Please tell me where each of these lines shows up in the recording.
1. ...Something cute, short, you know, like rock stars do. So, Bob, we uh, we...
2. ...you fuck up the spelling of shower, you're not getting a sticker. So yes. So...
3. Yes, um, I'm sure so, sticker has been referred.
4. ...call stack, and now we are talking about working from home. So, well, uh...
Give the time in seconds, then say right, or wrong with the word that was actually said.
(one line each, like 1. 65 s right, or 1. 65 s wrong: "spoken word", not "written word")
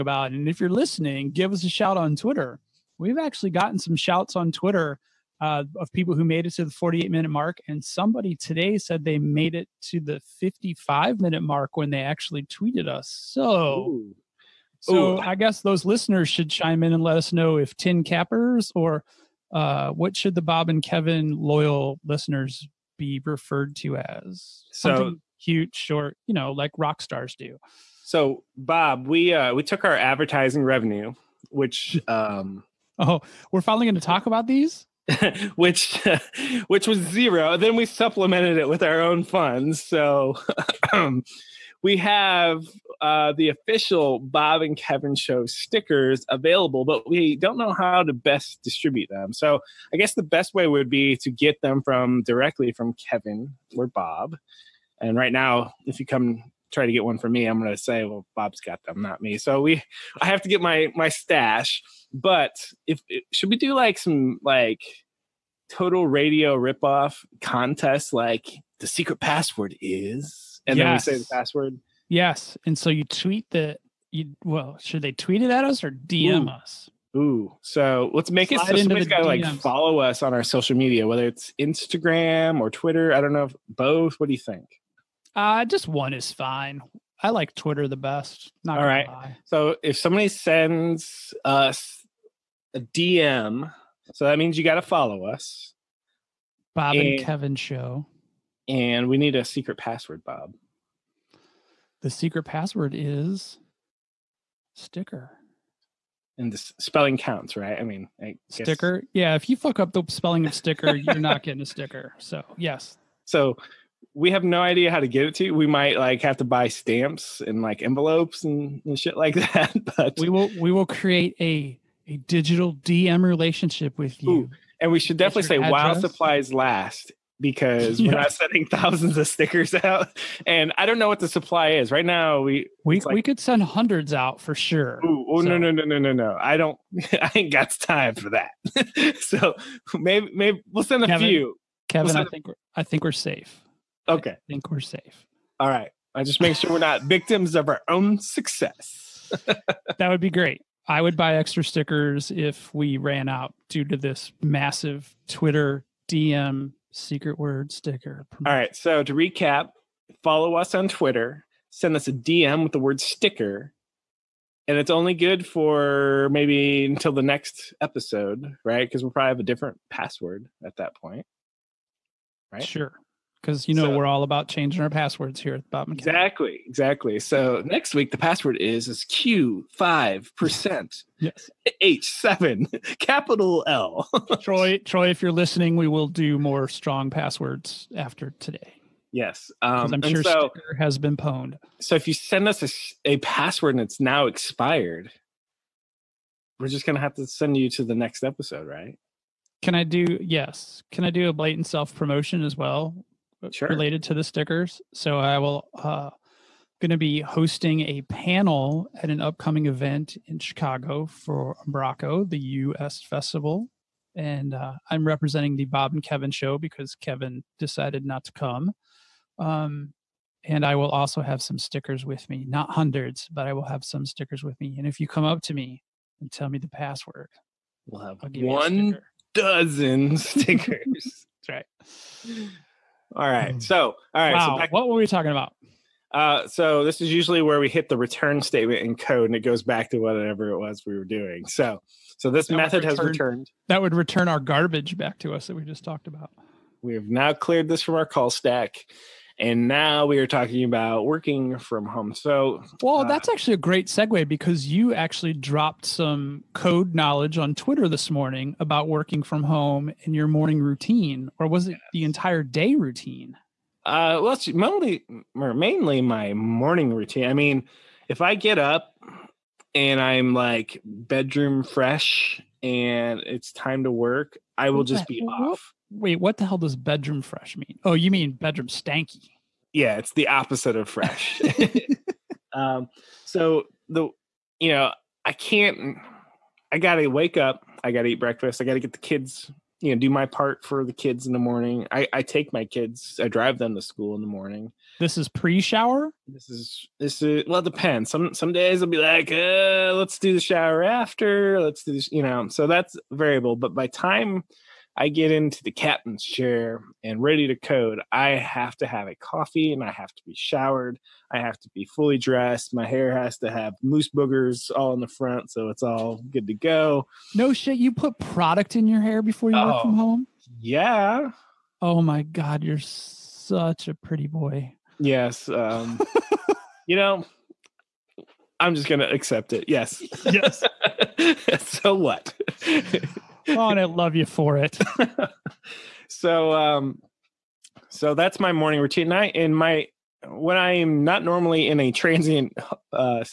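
1. 24 s right
2. 109 s wrong: "sticker", not "shower"
3. 189 s wrong: "pwned", not "referred"
4. 248 s right.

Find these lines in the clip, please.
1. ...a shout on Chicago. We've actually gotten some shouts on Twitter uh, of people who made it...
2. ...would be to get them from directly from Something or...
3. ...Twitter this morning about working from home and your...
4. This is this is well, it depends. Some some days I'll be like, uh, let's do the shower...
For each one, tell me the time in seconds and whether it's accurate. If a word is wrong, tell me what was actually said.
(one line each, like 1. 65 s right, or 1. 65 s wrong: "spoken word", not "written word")
1. 1 s wrong: "Twitter", not "Chicago"
2. 50 s wrong: "Kevin", not "Something"
3. 257 s right
4. 296 s right.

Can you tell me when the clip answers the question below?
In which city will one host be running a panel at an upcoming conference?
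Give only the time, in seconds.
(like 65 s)
210 s.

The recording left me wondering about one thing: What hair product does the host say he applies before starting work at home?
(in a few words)
mousse.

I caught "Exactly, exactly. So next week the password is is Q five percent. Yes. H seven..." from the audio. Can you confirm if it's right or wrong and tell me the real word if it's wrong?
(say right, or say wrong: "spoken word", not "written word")
right.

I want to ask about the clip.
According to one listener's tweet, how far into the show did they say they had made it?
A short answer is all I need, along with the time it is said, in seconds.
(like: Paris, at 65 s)
55 minute mark, at 10 s.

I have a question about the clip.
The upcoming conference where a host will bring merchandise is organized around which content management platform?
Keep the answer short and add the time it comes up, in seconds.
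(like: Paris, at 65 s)
Umbraco, at 211 s.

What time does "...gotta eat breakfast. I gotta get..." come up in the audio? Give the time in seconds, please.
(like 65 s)
287 s.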